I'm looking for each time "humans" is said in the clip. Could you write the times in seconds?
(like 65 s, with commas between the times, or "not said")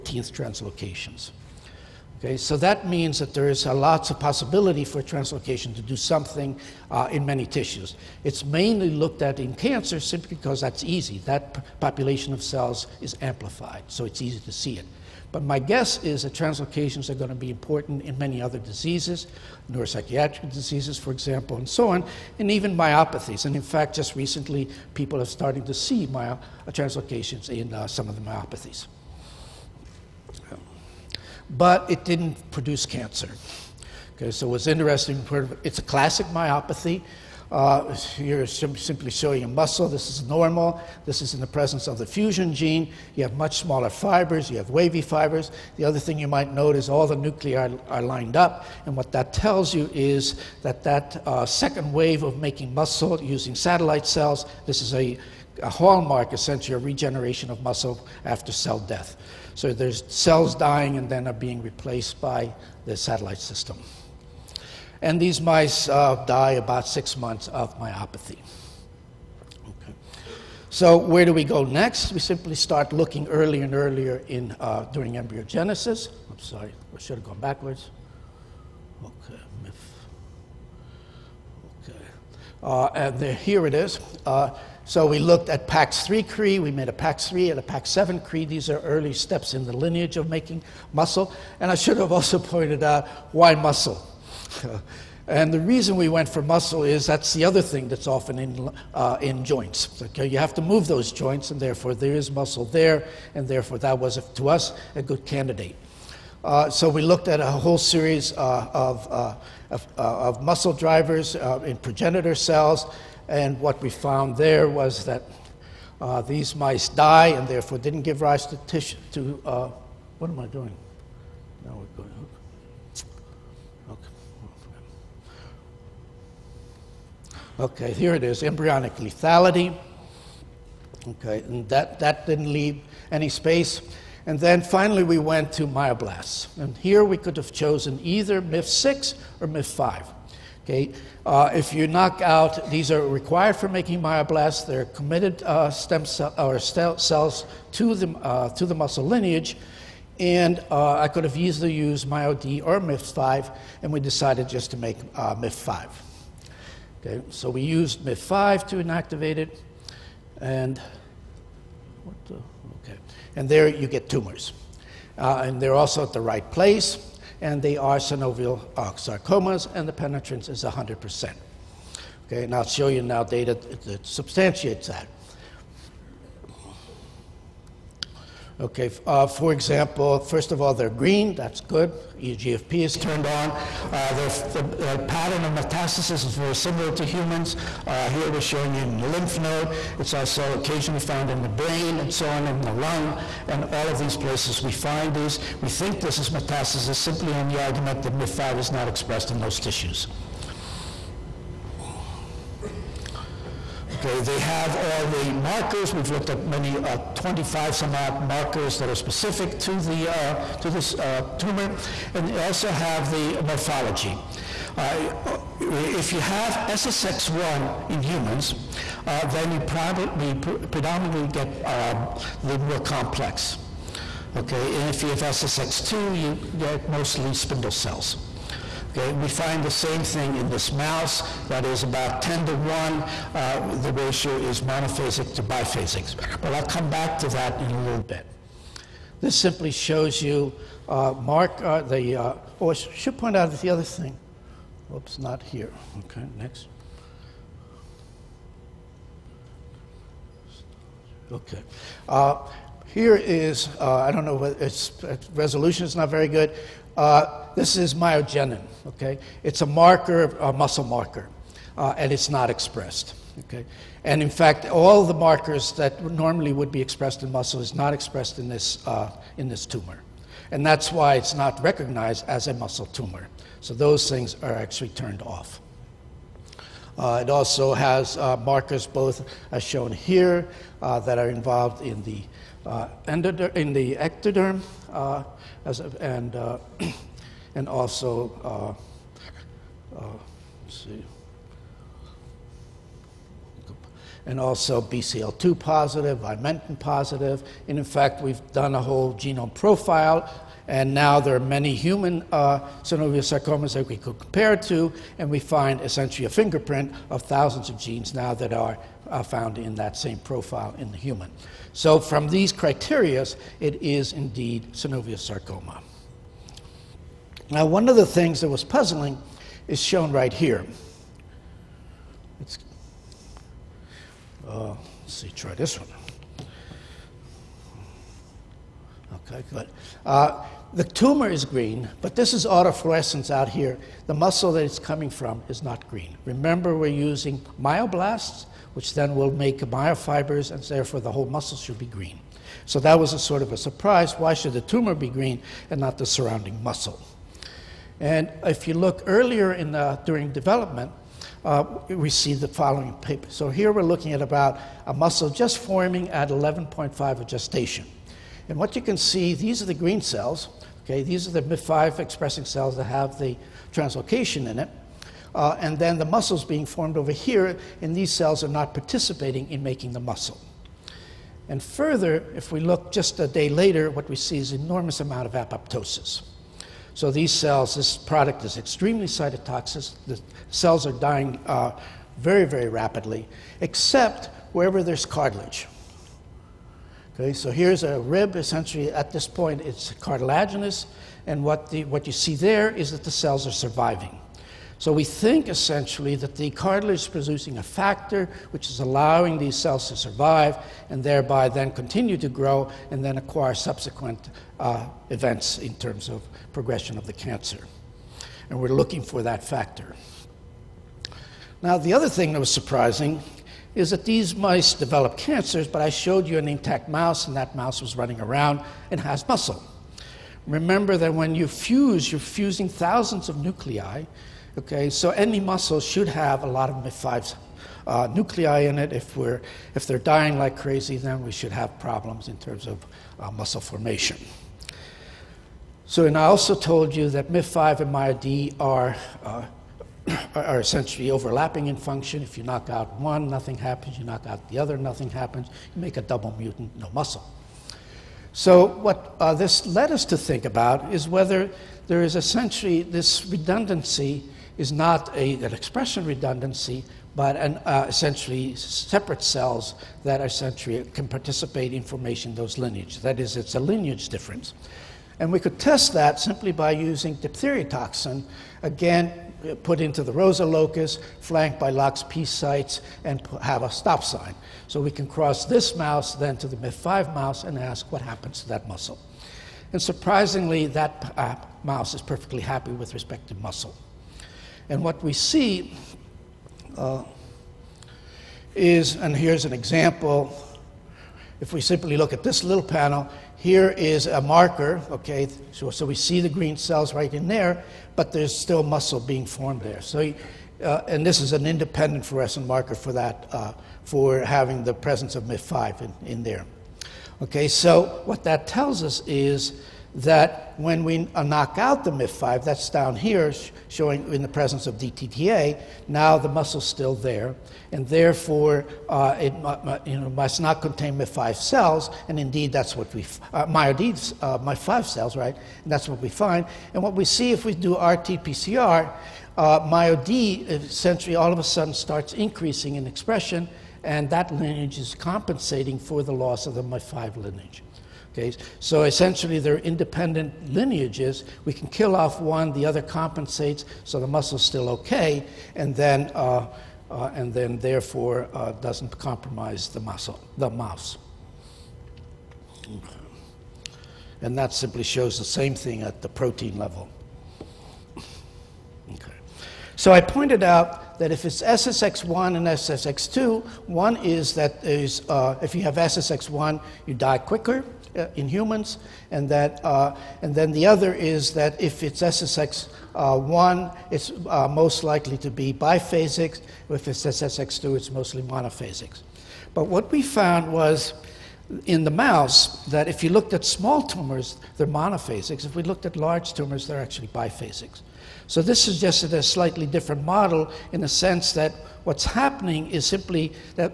187 s, 218 s, 301 s, 310 s, 568 s.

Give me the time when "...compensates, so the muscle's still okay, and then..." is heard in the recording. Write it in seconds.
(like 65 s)
542 s.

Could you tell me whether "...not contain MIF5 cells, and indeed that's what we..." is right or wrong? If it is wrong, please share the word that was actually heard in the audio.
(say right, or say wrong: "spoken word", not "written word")
right.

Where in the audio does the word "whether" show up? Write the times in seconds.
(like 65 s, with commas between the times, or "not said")
451 s.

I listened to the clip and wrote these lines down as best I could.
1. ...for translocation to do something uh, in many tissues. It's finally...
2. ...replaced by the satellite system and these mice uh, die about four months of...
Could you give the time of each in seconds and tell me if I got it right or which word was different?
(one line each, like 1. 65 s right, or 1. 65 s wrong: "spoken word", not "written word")
1. 4 s wrong: "mainly", not "finally"
2. 61 s wrong: "six", not "four".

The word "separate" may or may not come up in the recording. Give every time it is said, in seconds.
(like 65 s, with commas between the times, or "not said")
458 s.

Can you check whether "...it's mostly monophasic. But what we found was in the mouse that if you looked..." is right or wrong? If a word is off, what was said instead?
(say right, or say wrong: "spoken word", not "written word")
right.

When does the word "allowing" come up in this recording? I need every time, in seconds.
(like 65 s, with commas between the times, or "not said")
398 s.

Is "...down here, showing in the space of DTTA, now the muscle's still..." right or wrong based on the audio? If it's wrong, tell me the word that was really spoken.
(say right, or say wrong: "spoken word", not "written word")
wrong: "presence", not "space".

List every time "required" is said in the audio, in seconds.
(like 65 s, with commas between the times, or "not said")
143 s.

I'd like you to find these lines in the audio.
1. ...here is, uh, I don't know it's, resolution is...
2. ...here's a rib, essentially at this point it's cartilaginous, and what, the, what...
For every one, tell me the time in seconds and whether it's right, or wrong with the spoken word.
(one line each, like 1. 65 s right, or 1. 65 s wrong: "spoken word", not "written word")
1. 252 s right
2. 387 s right.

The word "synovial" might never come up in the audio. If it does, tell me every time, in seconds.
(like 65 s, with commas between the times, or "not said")
167 s, 302 s, 314 s.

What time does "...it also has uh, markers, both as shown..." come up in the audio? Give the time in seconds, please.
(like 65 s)
277 s.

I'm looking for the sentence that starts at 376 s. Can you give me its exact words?
So these cells, this product is extremely cytotoxic.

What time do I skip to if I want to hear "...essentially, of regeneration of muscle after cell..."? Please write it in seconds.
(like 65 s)
56 s.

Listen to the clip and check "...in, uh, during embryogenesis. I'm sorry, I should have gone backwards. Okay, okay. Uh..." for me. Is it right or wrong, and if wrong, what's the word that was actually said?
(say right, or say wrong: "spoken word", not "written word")
right.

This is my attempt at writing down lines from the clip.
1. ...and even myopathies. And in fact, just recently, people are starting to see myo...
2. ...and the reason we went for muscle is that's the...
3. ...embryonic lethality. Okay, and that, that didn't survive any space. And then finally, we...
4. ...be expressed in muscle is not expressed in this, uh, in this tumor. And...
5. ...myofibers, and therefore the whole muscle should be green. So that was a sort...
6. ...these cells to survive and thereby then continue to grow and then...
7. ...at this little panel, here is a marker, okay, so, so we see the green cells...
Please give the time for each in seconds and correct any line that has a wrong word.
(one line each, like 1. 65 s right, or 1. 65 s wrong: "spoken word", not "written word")
1. 22 s right
2. 95 s right
3. 128 s wrong: "leave", not "survive"
4. 266 s right
5. 339 s right
6. 399 s right
7. 492 s right.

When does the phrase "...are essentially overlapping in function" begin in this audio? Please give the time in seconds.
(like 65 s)
440 s.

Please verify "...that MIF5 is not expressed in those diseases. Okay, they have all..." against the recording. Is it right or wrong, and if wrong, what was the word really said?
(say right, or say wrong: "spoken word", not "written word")
wrong: "tissues", not "diseases".